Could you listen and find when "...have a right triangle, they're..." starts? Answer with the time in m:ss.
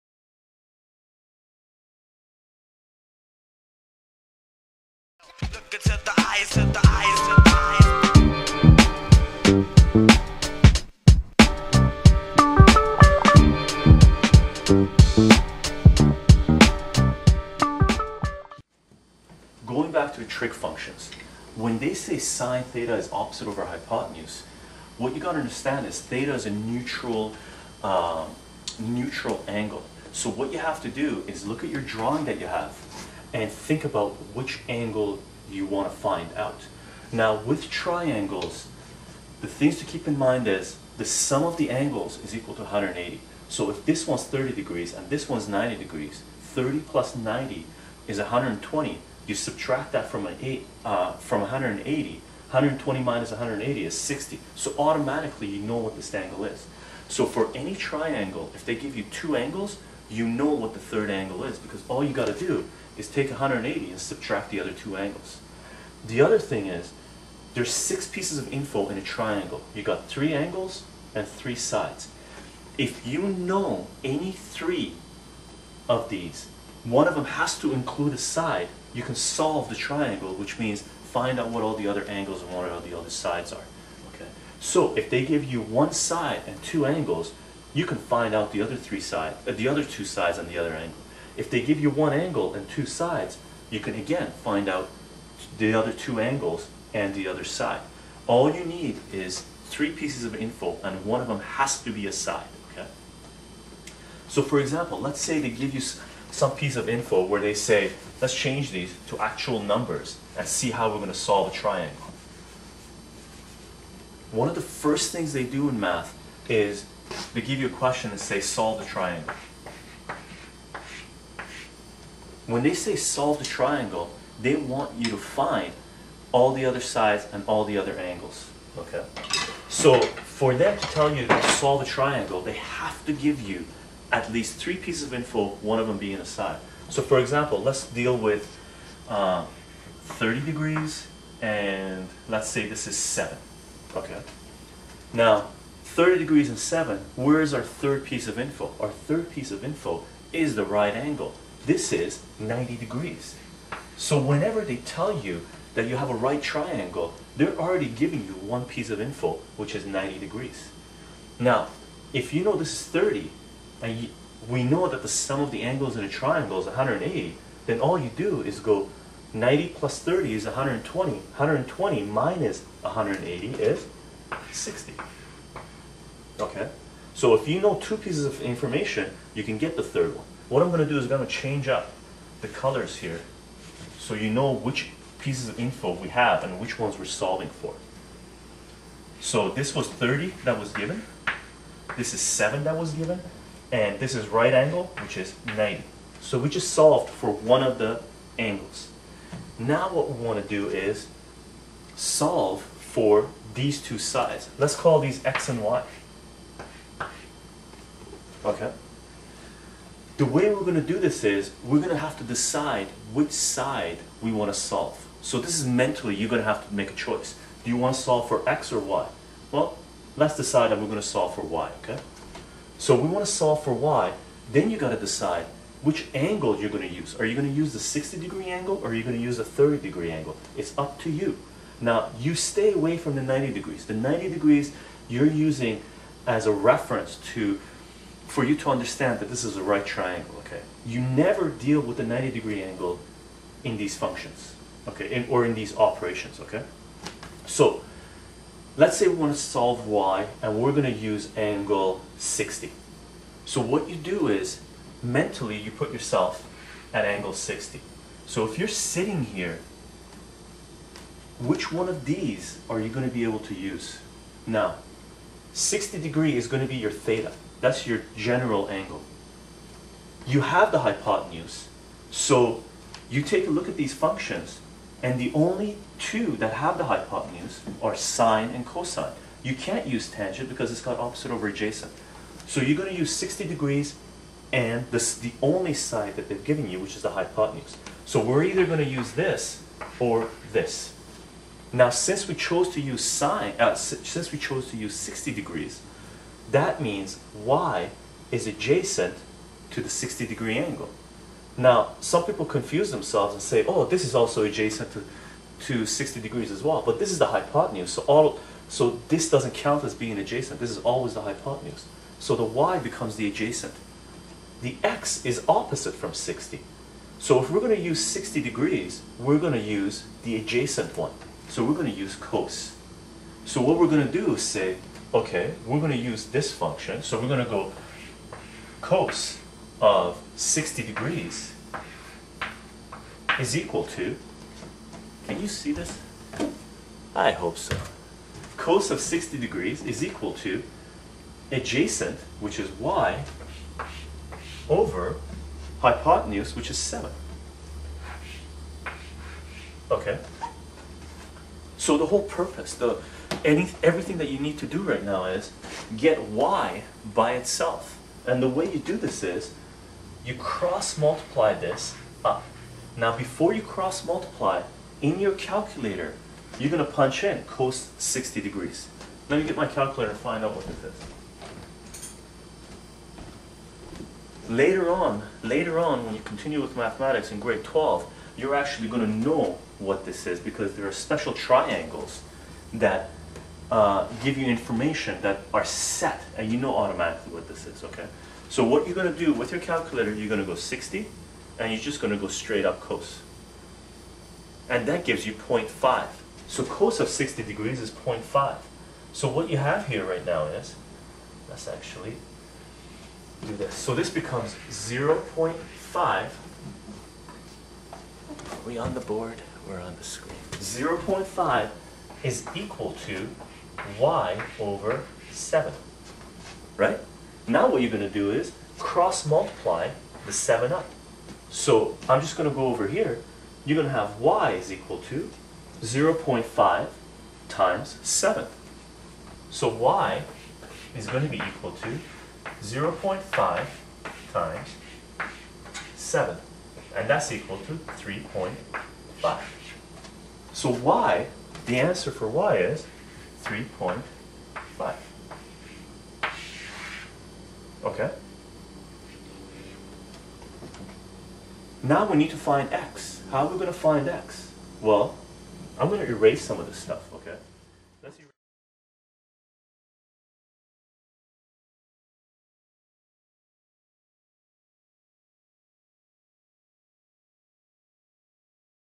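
2:35.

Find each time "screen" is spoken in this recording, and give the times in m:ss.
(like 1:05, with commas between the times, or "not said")
6:50.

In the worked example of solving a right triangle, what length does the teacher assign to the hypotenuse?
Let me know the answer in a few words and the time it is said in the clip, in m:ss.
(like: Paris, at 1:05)
7, at 2:22.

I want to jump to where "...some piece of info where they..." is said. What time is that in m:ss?
1:46.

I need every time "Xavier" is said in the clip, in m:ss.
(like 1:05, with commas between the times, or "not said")
not said.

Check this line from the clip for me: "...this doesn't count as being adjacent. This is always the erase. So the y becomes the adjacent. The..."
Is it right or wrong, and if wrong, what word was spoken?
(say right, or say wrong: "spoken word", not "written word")
wrong: "hypotenuse", not "erase".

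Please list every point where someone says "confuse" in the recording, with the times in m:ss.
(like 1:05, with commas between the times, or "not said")
5:02.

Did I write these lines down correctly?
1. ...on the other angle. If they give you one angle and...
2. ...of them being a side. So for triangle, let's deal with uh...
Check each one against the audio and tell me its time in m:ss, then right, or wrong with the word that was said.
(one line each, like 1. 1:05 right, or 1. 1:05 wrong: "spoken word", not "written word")
1. 1:30 right
2. 2:15 wrong: "example", not "triangle".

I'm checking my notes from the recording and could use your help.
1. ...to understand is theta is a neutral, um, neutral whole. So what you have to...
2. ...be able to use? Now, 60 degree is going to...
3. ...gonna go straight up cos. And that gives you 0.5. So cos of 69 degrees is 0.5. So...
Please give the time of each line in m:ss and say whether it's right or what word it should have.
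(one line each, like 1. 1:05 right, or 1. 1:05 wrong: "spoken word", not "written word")
1. 0:25 wrong: "angle", not "whole"
2. 4:23 right
3. 6:32 wrong: "60", not "69".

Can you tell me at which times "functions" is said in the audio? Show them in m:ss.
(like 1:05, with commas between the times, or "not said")
0:20, 4:03, 4:33, 5:26.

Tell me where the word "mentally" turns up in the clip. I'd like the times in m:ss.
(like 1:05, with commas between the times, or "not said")
3:35, 4:15.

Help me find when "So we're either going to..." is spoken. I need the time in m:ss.
4:48.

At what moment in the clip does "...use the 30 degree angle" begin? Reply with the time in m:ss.
3:49.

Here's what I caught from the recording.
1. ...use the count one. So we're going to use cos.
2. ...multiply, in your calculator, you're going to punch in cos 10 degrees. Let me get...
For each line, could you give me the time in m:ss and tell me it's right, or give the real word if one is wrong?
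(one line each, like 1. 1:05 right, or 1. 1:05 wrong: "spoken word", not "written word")
1. 5:19 wrong: "adjacent", not "count"
2. 6:04 wrong: "60", not "10".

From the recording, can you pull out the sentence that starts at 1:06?
The other thing is, there's six pieces of info in a triangle.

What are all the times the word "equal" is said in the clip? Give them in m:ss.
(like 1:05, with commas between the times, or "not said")
0:42, 5:33, 5:40, 6:52, 7:04, 7:11, 7:17.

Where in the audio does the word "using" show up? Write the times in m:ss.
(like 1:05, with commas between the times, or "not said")
3:55.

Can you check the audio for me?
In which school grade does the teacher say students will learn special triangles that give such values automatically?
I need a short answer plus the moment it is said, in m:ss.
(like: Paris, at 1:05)
grade 12, at 6:17.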